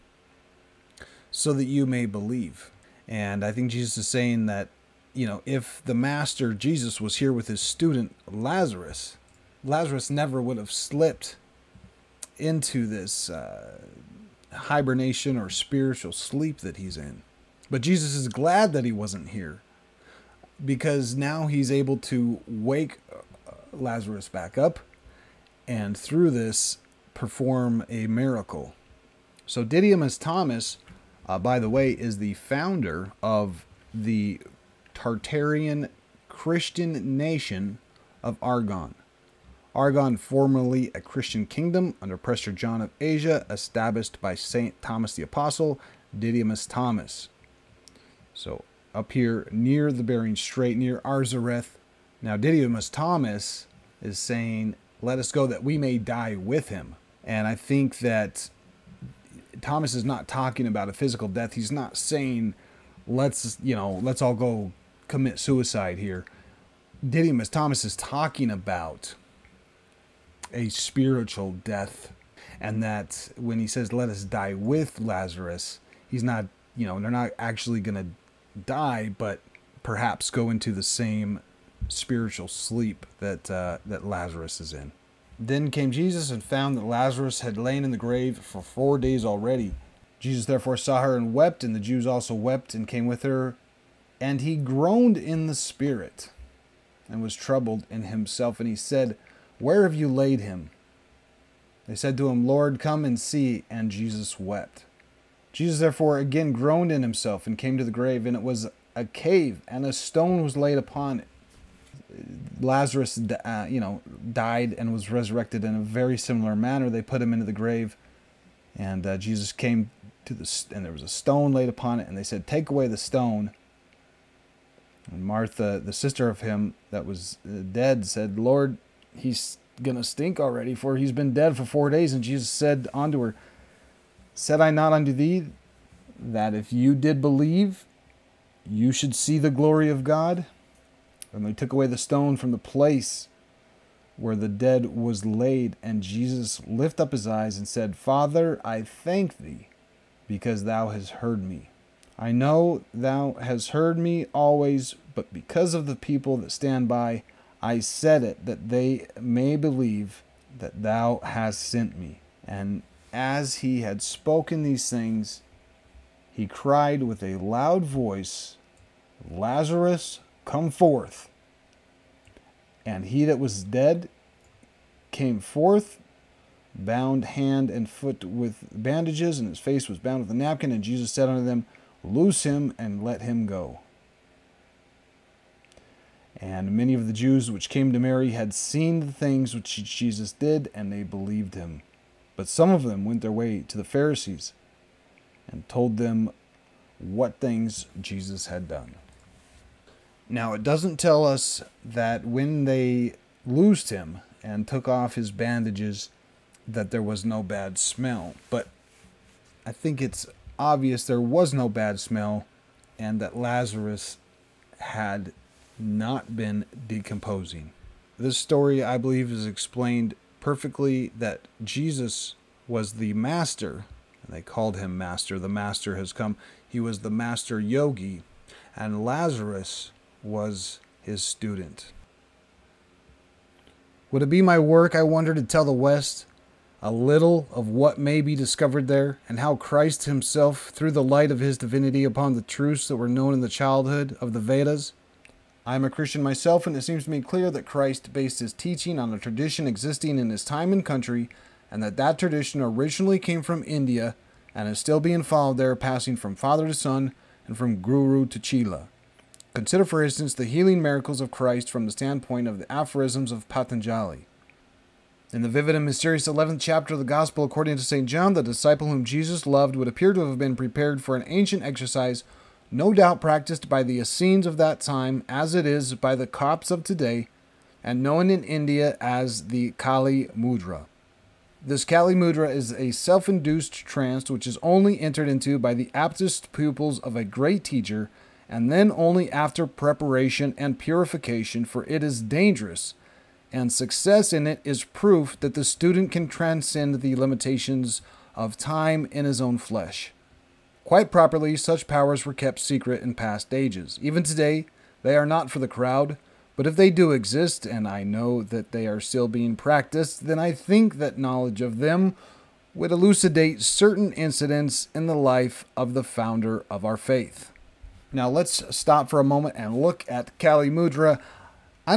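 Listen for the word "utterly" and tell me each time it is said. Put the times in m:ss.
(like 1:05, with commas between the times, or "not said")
not said.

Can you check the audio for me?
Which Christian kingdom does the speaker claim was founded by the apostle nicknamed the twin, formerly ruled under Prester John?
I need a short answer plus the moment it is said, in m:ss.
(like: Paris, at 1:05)
Argon, at 0:34.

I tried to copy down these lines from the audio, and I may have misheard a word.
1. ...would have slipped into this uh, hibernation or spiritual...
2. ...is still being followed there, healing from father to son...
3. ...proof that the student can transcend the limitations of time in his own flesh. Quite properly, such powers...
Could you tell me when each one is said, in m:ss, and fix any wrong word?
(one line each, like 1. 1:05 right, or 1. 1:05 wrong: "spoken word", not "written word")
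1. 0:10 right
2. 4:14 wrong: "passing", not "healing"
3. 4:54 right.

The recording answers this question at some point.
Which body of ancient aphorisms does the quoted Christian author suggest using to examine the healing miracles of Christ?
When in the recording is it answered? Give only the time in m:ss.
4:23.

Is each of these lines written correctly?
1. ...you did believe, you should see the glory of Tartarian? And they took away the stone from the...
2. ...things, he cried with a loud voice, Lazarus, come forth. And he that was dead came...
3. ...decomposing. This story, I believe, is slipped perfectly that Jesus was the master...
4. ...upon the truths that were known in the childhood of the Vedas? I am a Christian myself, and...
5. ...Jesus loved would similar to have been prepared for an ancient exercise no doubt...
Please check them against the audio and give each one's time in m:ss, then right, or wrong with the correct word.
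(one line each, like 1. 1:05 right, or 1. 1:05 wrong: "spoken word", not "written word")
1. 2:16 wrong: "God", not "Tartarian"
2. 2:44 right
3. 3:36 wrong: "explained", not "slipped"
4. 4:02 right
5. 4:29 wrong: "appear", not "similar".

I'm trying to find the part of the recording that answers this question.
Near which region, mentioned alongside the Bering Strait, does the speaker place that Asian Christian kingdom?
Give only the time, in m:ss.
0:51.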